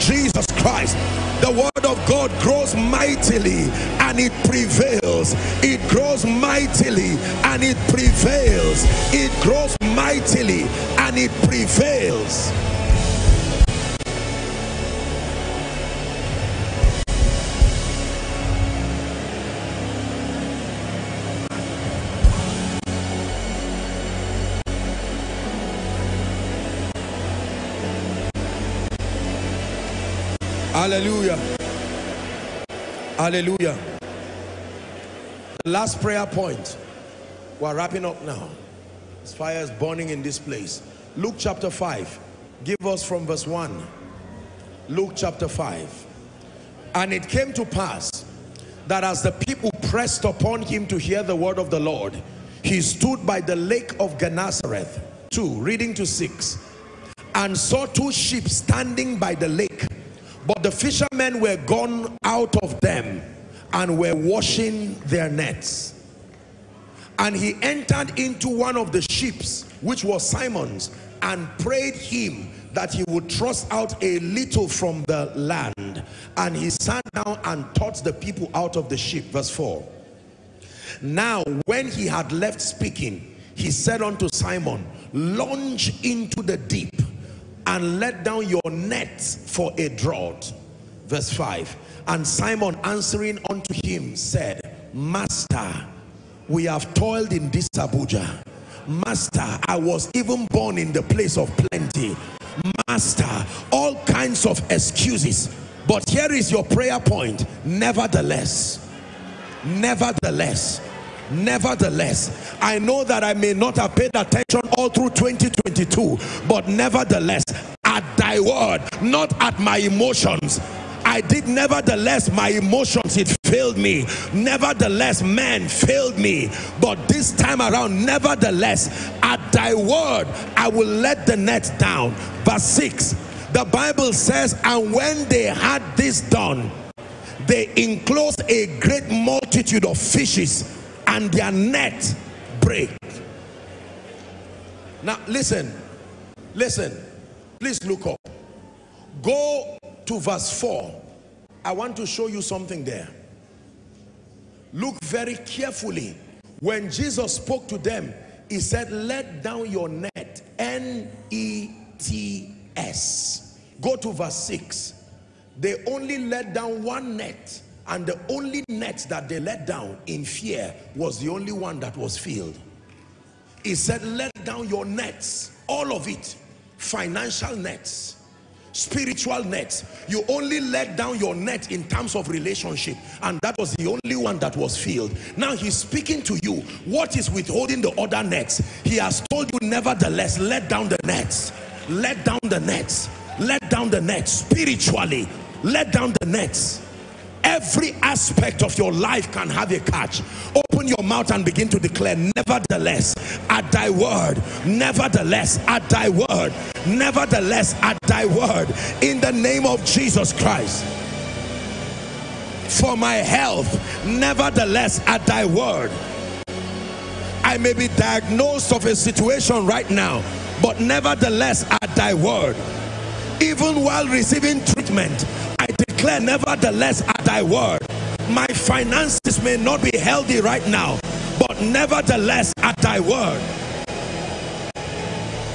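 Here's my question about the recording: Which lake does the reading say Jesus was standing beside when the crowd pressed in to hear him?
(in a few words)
Gennesareth.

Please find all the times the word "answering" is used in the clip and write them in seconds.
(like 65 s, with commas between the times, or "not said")
92 s.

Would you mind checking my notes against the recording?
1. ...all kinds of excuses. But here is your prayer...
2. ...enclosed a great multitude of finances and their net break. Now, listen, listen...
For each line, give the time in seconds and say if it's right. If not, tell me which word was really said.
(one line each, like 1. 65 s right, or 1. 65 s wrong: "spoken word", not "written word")
1. 103 s right
2. 137 s wrong: "fishes", not "finances".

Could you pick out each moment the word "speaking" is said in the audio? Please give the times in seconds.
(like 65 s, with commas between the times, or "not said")
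82 s, 185 s.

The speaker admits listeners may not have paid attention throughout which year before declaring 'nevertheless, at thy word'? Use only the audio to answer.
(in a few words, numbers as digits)
2022.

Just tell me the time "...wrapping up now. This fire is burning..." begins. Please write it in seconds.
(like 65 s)
37 s.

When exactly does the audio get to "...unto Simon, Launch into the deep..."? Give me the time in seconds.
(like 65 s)
84 s.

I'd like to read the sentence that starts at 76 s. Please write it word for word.
And he sat down and taught the people out of the ship.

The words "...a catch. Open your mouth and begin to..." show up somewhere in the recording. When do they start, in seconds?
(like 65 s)
199 s.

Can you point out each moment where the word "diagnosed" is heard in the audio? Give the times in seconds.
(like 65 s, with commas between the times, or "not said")
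217 s.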